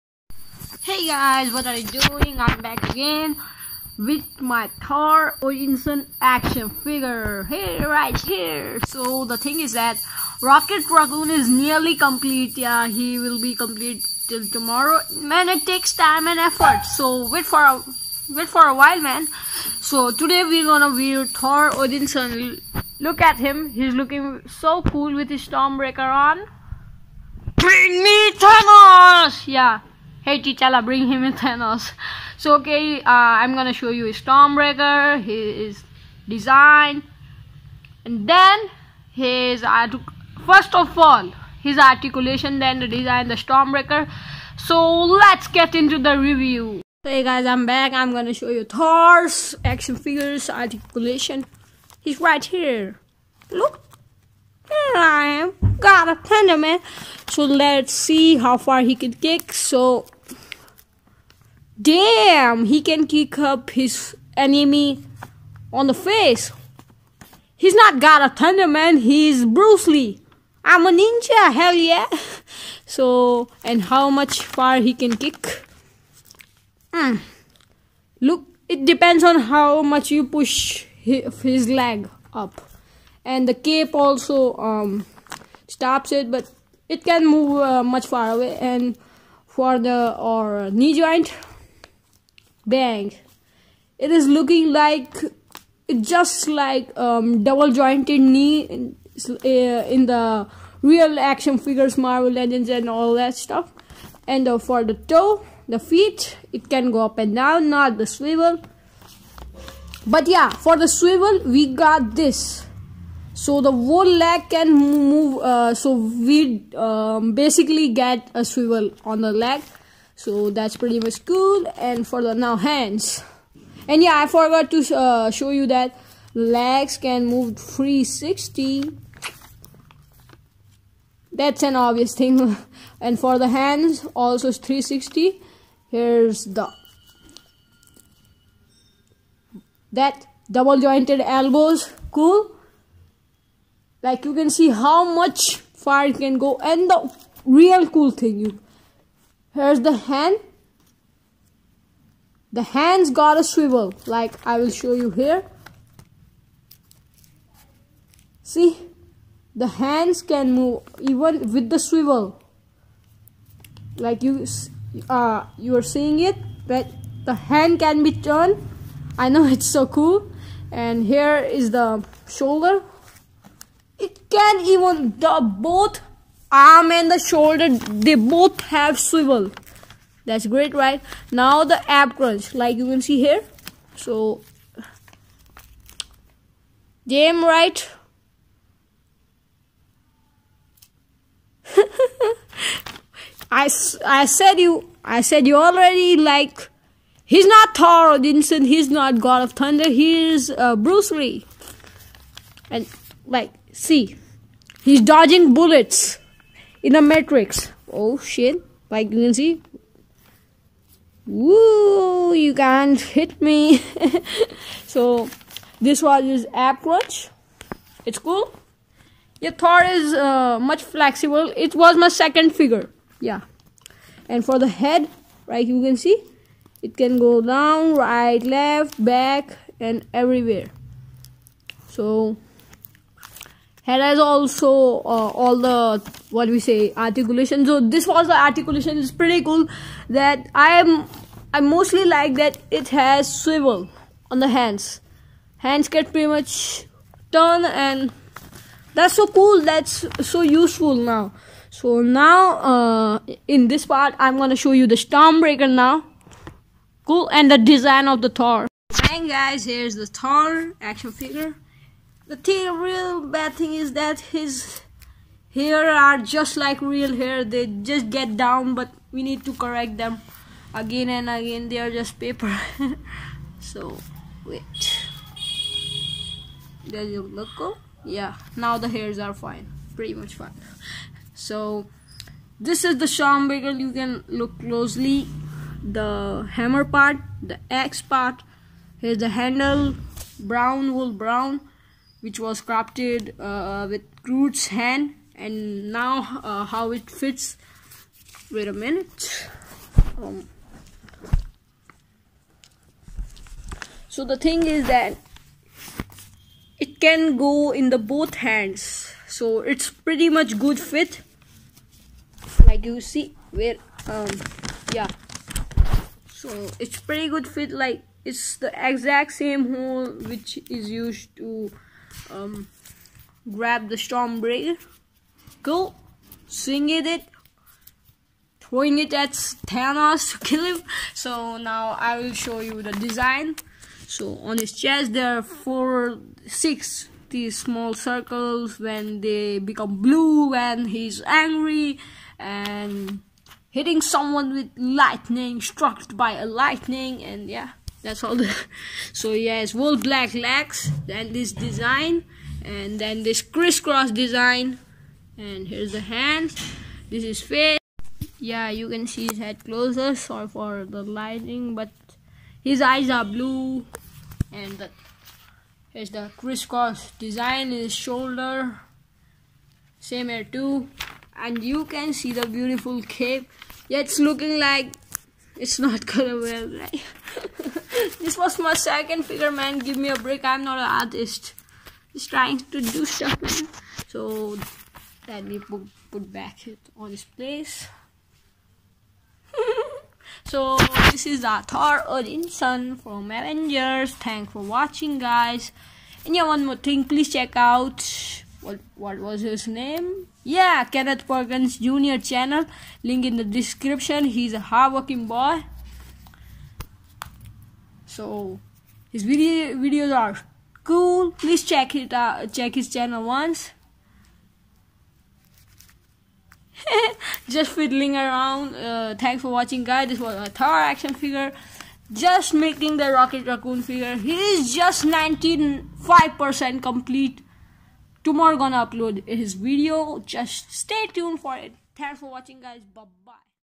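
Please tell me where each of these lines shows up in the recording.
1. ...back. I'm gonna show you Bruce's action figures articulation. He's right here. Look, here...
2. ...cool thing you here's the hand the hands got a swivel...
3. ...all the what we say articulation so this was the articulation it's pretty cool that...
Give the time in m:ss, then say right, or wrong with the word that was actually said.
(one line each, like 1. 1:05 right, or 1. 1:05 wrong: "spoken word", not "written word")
1. 0:47 wrong: "Thor", not "Bruce"
2. 2:27 right
3. 3:55 right.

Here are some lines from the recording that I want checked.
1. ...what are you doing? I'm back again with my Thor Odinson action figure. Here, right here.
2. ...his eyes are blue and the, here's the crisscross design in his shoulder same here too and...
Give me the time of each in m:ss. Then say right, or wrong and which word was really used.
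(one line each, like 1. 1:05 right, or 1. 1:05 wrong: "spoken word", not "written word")
1. 0:01 right
2. 6:02 right.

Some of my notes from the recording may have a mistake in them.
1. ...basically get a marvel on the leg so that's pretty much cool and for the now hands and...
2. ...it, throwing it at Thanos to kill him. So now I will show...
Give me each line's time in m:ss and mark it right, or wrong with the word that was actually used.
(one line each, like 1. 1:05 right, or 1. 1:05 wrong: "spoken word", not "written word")
1. 1:57 wrong: "swivel", not "marvel"
2. 5:27 right.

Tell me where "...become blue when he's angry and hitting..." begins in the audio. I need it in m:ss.
5:39.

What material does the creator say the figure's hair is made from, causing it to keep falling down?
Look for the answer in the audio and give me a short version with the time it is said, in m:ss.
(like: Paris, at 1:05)
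Paper, at 4:32.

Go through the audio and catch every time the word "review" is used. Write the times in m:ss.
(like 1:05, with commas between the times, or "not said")
0:46.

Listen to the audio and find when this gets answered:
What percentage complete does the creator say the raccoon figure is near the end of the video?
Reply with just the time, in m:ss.
7:05.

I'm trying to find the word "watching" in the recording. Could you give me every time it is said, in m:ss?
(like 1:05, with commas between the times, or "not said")
6:34, 6:59, 7:12.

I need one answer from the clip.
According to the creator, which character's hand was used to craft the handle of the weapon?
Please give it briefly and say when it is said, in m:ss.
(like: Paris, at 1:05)
Groot, at 4:54.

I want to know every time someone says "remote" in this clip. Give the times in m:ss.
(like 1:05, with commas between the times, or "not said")
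not said.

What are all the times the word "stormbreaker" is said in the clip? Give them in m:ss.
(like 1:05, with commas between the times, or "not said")
0:25, 0:34, 0:43, 4:15, 4:43, 5:23.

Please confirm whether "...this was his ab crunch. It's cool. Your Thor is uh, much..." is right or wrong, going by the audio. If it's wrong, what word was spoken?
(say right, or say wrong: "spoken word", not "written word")
right.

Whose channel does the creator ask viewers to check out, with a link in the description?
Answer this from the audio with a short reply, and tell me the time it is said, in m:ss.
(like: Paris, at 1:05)
Kenneth Perkins Jr., at 6:40.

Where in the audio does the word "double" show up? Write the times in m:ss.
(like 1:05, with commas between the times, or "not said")
1:37, 2:20.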